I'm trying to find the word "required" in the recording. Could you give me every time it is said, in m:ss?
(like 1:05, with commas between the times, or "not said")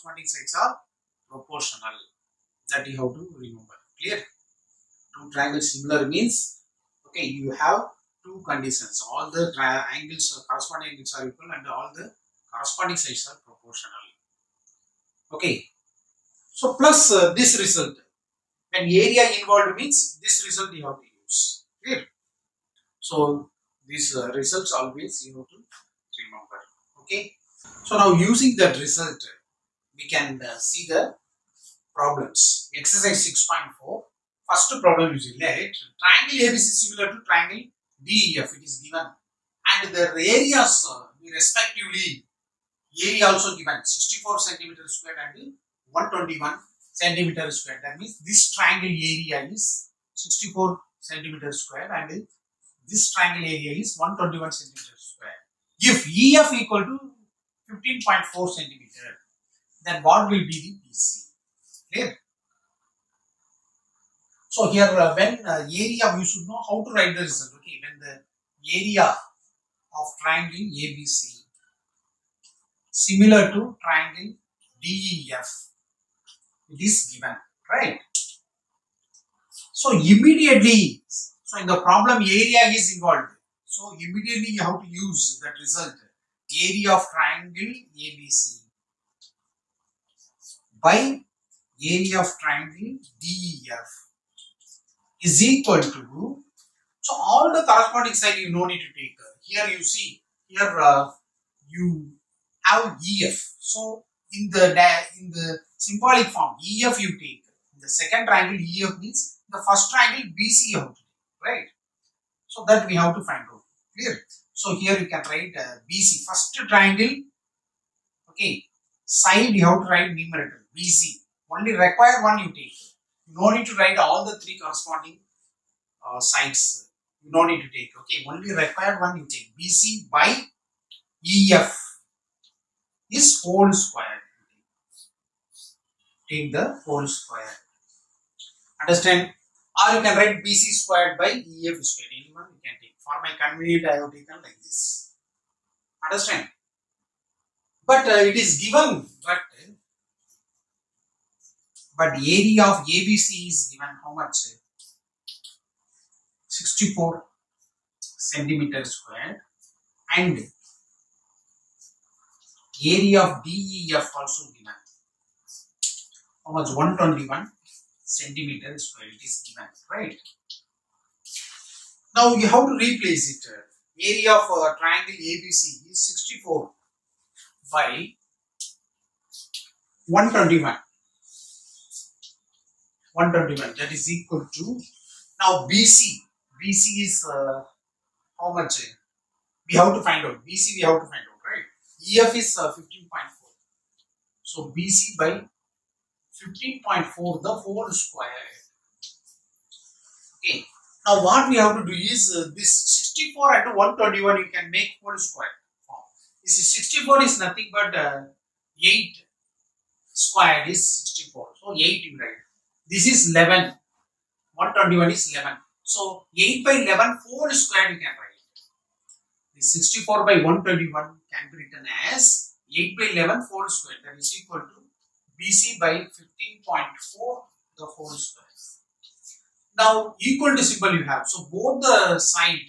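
2:01, 2:08.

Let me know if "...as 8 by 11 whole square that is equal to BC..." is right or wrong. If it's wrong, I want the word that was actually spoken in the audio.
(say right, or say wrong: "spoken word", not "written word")
right.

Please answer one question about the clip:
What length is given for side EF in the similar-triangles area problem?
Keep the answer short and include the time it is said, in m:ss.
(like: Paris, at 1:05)
15.4 centimeters, at 0:57.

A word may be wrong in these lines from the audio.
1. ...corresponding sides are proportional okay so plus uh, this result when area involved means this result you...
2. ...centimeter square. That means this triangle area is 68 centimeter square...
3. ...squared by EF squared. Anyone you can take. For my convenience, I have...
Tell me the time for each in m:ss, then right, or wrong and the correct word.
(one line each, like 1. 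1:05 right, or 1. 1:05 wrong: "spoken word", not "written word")
1. 0:12 right
2. 0:46 wrong: "64", not "68"
3. 2:20 right.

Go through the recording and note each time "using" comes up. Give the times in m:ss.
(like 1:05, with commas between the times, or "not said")
0:28.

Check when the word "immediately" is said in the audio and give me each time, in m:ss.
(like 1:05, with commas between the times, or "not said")
1:19, 1:23.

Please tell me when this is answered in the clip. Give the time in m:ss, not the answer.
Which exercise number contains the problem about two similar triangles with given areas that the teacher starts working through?
0:32.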